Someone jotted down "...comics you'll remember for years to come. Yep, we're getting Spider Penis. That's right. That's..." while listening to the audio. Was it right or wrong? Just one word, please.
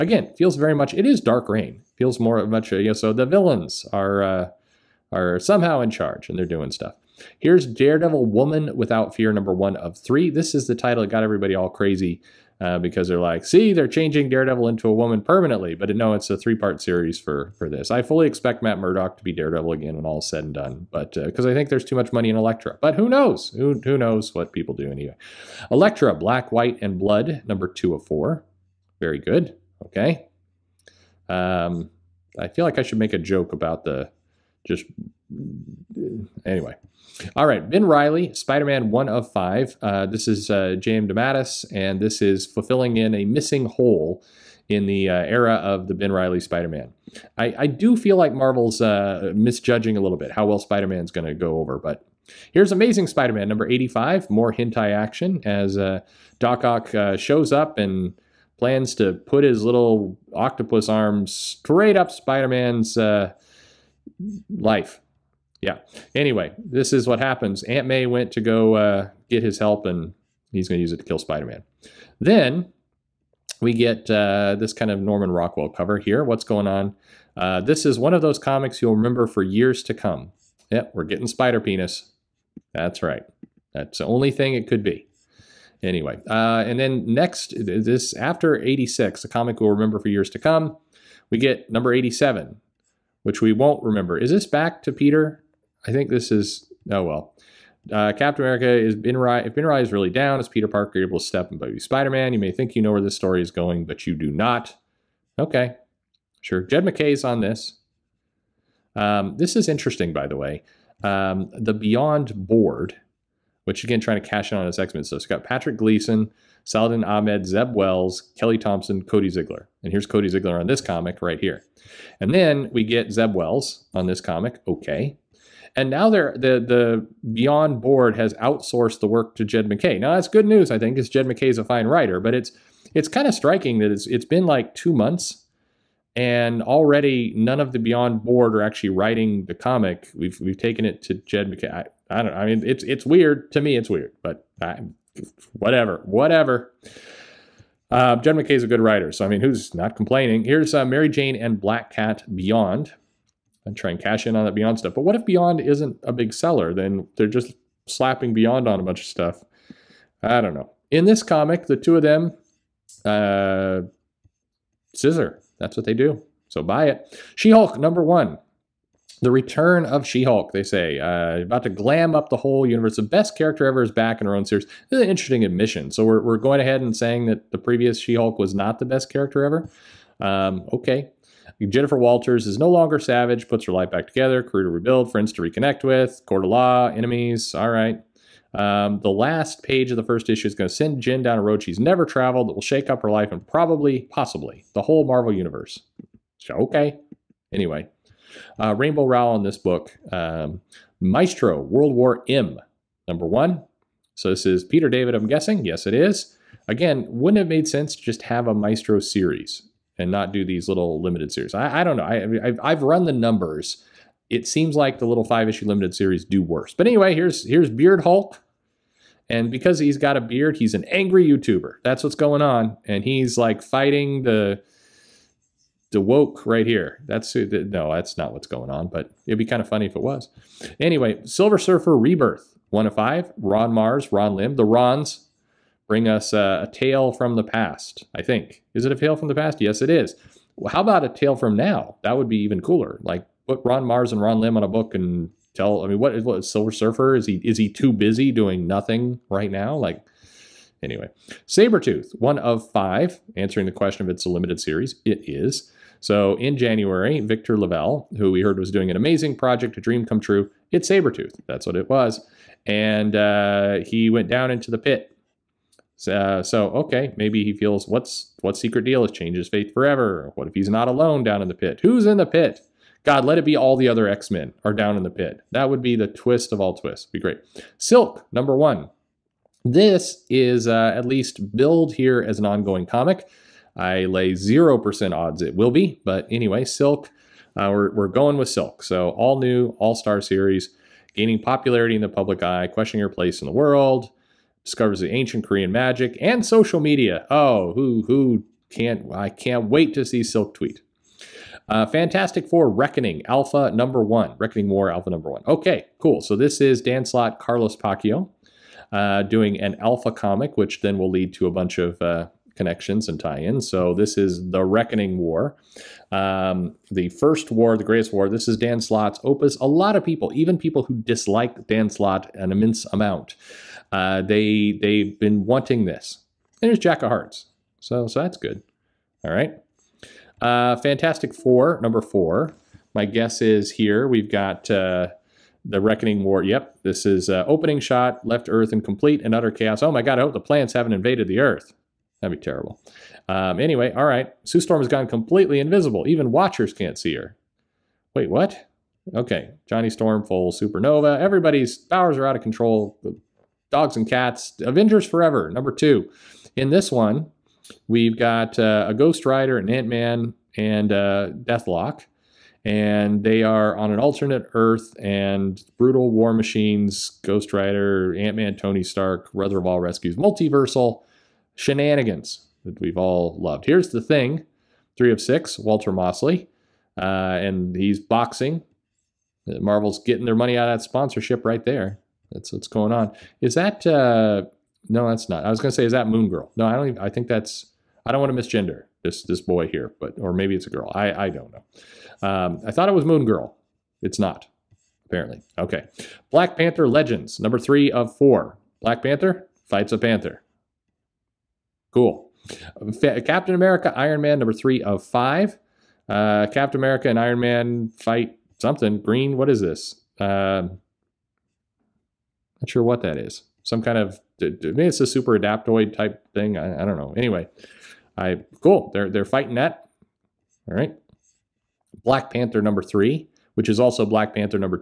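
right.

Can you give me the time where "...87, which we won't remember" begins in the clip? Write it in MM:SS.
01:31.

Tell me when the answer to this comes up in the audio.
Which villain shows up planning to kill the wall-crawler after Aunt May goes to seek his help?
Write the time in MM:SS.
00:56.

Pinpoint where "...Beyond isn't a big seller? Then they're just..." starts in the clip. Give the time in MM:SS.
02:35.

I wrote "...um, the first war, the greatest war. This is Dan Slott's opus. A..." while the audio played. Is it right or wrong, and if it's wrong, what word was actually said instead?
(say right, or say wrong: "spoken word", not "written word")
right.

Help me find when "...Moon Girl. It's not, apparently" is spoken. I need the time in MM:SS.
06:33.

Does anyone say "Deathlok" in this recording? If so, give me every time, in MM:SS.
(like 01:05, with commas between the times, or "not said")
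06:01.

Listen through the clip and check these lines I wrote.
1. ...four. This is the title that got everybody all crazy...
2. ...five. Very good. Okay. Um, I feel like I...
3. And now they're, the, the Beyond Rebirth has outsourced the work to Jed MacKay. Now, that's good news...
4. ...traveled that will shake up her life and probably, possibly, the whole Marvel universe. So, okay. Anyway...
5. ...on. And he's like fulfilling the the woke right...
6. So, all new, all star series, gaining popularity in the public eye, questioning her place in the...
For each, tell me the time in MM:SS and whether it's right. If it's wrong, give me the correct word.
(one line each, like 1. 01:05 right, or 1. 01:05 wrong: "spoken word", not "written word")
1. 00:09 wrong: "three", not "four"
2. 00:28 wrong: "four", not "five"
3. 02:05 wrong: "Board", not "Rebirth"
4. 03:12 right
5. 03:42 wrong: "fighting", not "fulfilling"
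6. 04:48 right.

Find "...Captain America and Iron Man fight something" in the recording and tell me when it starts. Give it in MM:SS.
06:46.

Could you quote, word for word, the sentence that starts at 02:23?
It's weird, but I, whatever, whatever.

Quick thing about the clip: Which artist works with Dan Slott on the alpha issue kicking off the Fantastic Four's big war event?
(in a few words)
Carlos Pacheco.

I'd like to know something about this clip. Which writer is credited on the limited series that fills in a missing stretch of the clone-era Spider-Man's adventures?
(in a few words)
DeMatteis.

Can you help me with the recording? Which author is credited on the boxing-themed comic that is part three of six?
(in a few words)
Walter Mosley.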